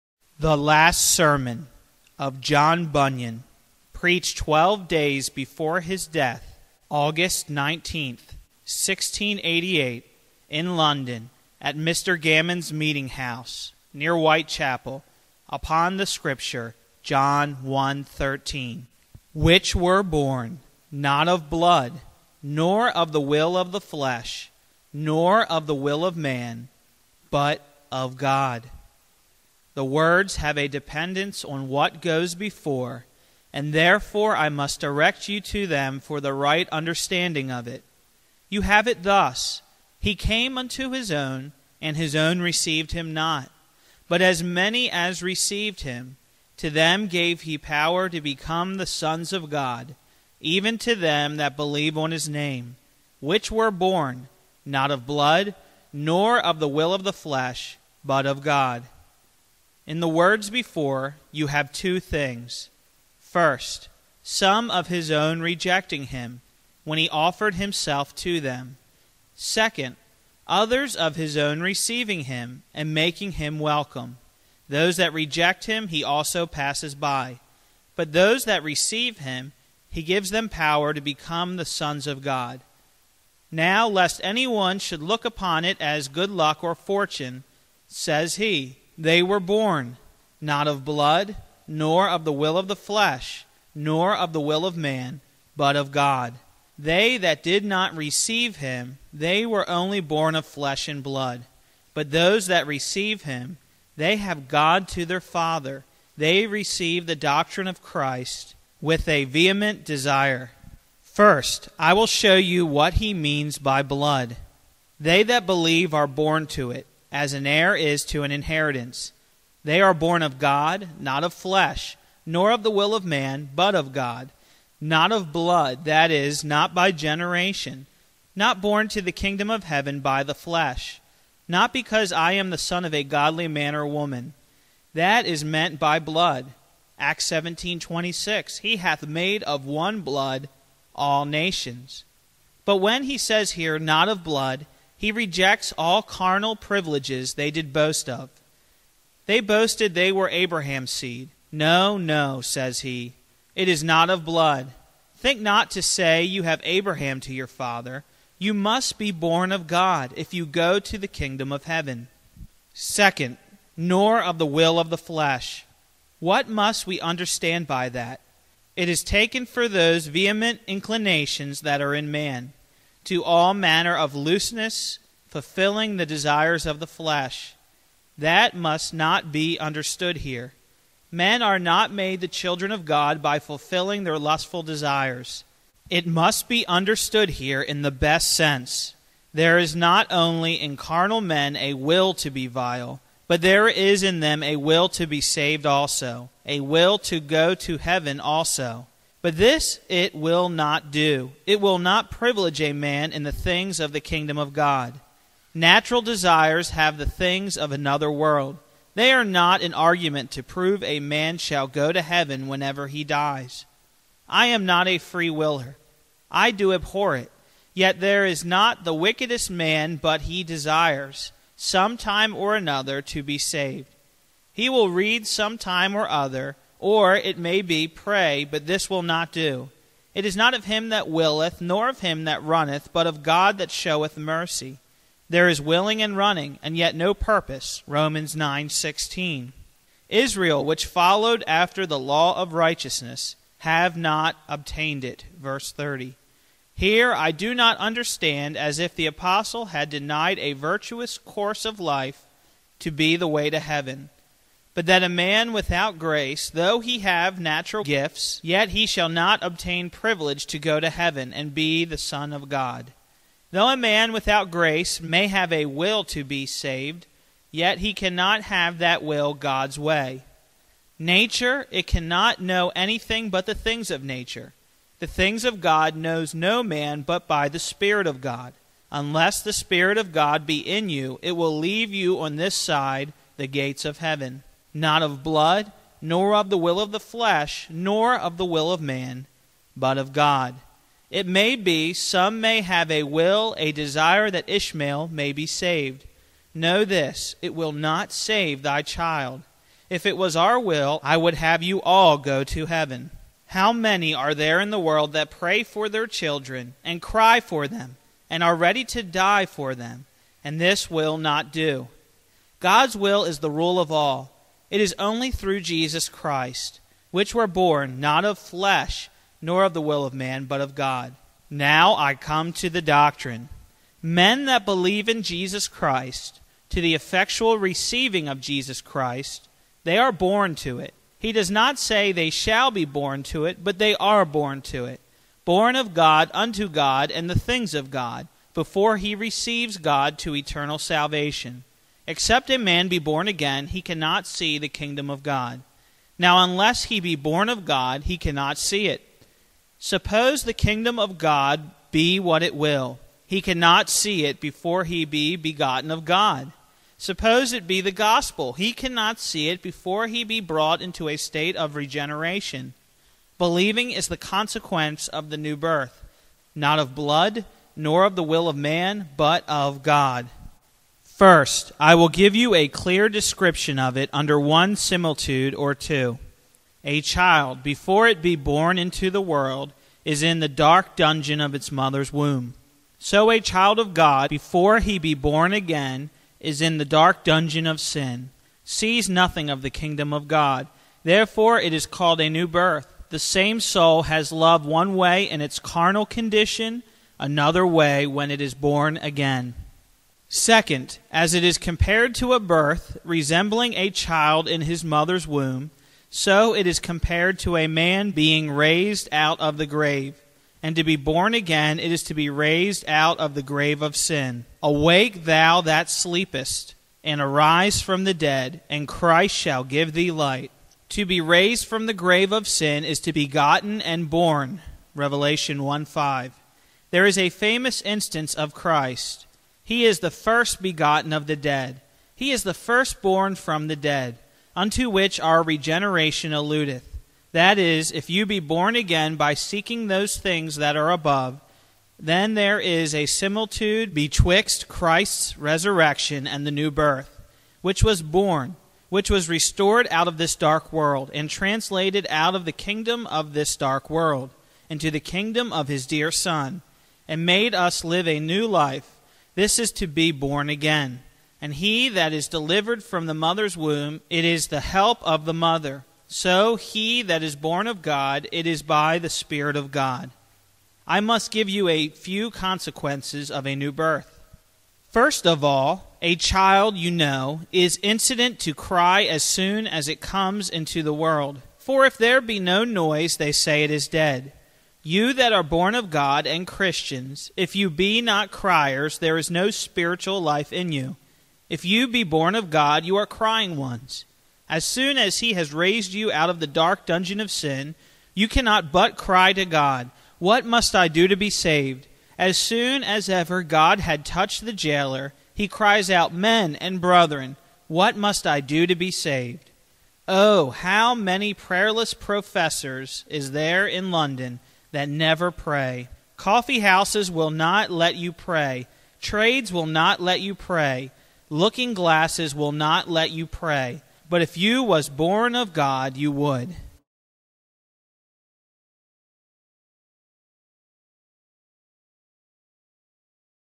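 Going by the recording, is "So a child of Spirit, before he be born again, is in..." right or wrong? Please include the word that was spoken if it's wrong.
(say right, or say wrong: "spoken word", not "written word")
wrong: "God", not "Spirit".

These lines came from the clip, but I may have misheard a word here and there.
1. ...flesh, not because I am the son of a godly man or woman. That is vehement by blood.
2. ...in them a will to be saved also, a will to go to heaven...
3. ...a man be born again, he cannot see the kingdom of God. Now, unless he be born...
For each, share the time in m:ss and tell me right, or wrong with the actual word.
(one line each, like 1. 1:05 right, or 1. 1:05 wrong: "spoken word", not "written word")
1. 2:10 wrong: "meant", not "vehement"
2. 3:14 right
3. 5:42 right.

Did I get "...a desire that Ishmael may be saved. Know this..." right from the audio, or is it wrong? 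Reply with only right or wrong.
right.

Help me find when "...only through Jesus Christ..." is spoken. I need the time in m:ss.
5:14.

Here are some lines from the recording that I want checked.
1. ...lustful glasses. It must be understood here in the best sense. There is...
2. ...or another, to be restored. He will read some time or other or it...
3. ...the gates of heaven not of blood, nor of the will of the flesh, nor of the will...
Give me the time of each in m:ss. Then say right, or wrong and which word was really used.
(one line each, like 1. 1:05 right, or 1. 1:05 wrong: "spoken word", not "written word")
1. 3:04 wrong: "desires", not "glasses"
2. 3:42 wrong: "saved", not "restored"
3. 4:43 right.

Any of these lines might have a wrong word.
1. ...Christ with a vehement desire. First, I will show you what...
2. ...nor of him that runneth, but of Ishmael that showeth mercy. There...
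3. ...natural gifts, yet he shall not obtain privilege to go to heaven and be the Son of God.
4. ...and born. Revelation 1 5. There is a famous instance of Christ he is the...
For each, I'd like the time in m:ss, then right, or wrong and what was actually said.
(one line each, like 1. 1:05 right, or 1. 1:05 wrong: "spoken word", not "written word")
1. 1:47 right
2. 3:51 wrong: "God", not "Ishmael"
3. 4:17 right
4. 7:03 right.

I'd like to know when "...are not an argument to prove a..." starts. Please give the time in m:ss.
3:29.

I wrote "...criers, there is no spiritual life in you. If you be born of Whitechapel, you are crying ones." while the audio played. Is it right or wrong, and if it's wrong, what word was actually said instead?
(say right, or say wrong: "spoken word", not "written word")
wrong: "God", not "Whitechapel".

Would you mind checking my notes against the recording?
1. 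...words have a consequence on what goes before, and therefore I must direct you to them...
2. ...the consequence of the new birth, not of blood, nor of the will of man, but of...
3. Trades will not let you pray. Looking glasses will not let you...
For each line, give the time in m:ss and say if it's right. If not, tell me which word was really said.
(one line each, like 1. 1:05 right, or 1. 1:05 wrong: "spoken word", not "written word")
1. 0:29 wrong: "dependence", not "consequence"
2. 6:04 right
3. 8:39 right.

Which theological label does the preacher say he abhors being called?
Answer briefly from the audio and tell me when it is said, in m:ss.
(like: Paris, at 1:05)
A free willer, at 3:34.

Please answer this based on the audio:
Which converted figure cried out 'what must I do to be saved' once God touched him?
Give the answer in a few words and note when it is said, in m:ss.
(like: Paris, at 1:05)
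The jailer, at 8:24.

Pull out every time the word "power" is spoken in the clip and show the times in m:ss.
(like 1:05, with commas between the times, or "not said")
0:47, 1:20.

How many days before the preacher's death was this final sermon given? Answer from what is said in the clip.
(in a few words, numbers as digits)
12.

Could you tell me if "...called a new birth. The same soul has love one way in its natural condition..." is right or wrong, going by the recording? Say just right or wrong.
wrong.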